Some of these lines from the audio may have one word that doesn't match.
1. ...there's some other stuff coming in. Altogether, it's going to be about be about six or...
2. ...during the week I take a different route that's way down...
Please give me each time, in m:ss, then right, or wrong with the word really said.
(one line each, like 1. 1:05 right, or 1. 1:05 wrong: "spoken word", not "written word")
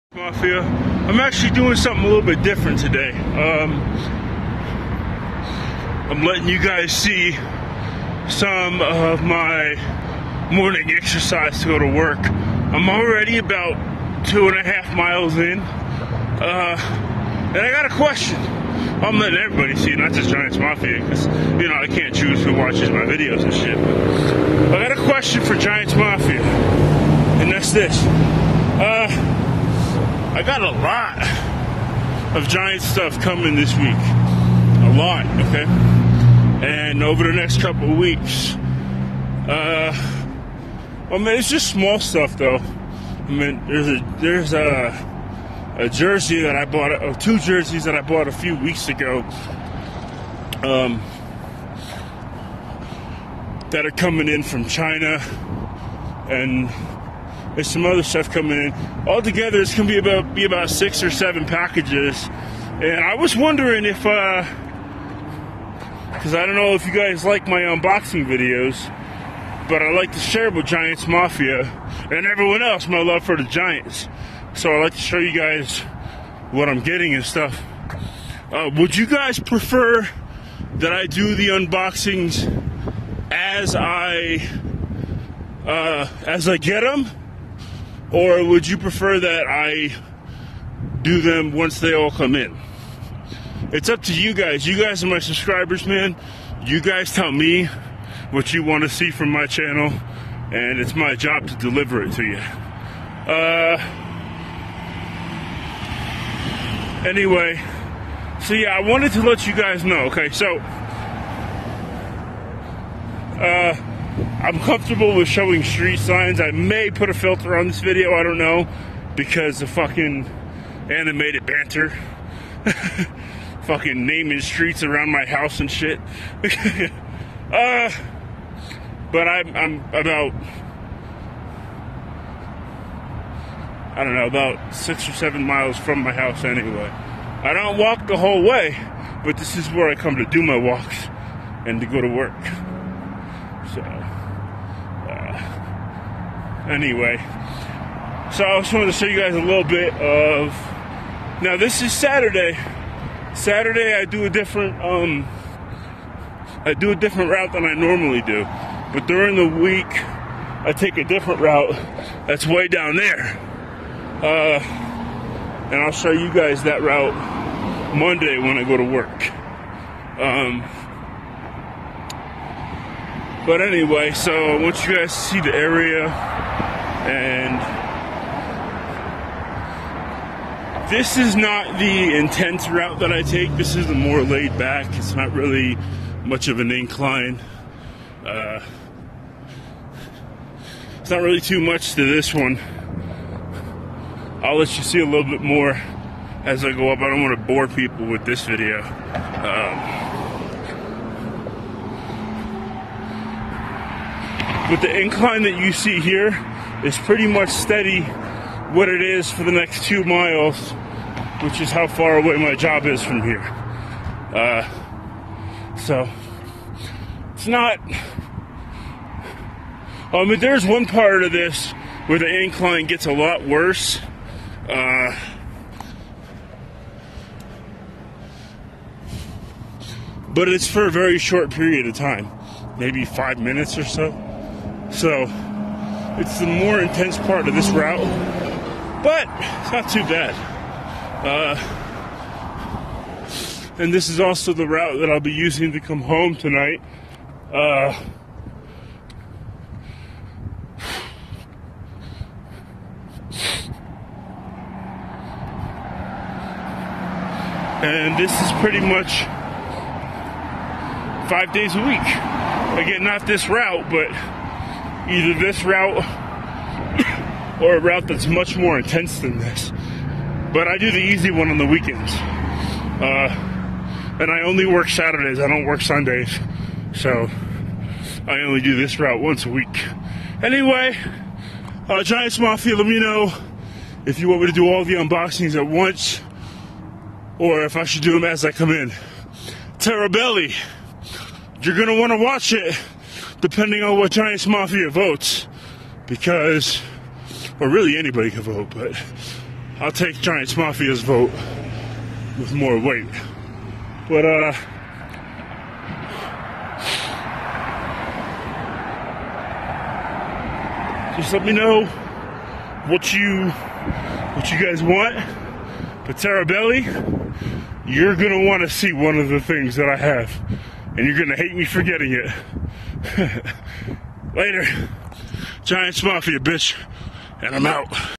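1. 0:57 right
2. 2:39 right.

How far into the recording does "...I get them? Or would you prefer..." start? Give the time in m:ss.
1:26.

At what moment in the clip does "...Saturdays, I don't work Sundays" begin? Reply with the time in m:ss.
4:34.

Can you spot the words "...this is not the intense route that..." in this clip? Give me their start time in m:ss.
3:00.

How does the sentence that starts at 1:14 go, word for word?
So I like to show you guys what I'm getting and stuff.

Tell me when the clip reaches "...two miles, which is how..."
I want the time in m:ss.
3:29.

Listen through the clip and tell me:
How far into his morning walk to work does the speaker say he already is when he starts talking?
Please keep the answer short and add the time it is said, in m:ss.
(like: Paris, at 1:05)
2.5 miles, at 0:14.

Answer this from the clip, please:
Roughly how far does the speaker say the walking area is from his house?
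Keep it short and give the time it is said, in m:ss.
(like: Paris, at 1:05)
6 or 7 miles, at 2:14.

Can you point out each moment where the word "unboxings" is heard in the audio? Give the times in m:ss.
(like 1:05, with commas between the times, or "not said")
1:07, 1:21, 4:44.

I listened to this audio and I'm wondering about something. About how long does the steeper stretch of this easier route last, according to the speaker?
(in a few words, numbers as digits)
5 minutes.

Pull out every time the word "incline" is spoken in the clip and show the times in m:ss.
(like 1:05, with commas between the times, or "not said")
3:06, 3:25, 3:42.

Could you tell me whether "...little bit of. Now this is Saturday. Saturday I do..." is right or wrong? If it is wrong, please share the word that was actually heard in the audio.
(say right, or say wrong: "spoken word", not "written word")
right.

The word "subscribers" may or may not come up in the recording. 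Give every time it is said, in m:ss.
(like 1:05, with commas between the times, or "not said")
1:35.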